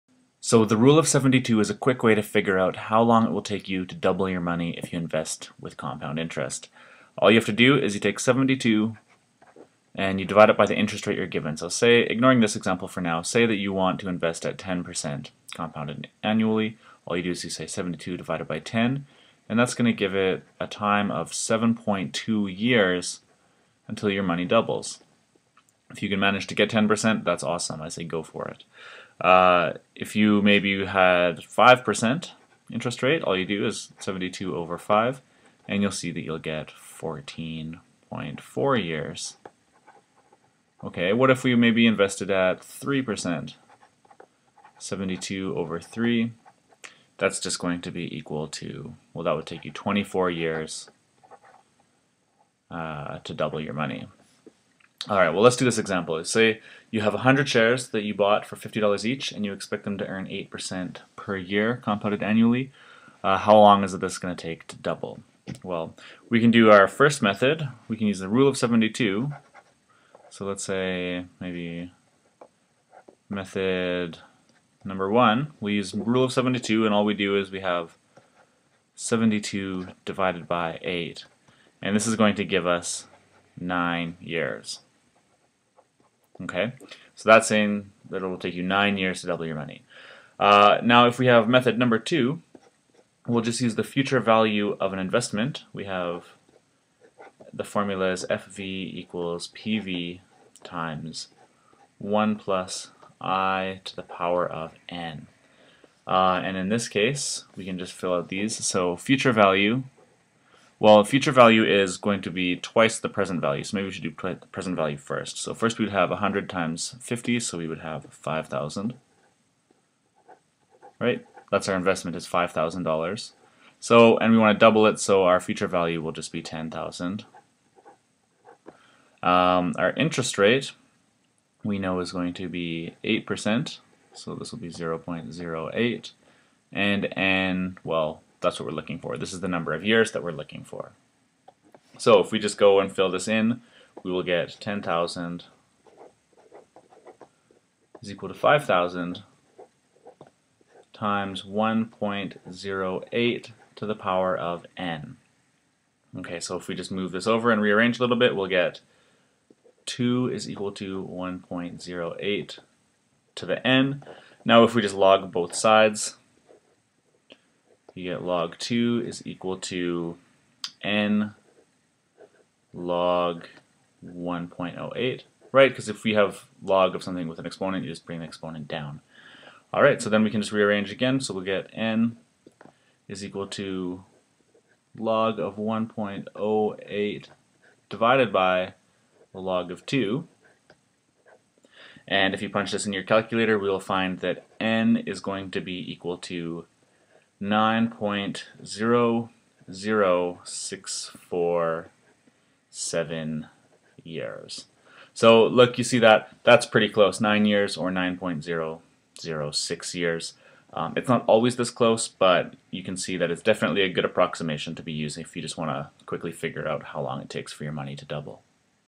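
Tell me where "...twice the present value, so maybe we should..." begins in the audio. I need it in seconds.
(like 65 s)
112 s.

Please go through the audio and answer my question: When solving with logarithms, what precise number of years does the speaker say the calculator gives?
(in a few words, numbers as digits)
9.00647 years.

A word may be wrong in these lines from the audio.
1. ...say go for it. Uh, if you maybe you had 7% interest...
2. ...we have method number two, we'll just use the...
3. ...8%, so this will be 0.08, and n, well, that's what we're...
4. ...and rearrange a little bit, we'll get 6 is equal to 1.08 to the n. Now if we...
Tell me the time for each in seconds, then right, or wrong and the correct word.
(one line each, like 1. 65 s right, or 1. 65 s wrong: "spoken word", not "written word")
1. 27 s wrong: "5", not "7"
2. 91 s right
3. 133 s right
4. 157 s wrong: "2", not "6".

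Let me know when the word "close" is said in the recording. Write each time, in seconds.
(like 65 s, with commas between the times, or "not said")
206 s, 211 s.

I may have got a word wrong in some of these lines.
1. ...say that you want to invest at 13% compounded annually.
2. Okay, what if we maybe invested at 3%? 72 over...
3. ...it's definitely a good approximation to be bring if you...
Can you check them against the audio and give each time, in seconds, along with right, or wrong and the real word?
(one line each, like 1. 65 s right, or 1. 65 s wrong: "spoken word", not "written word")
1. 13 s wrong: "10", not "13"
2. 40 s right
3. 213 s wrong: "using", not "bring".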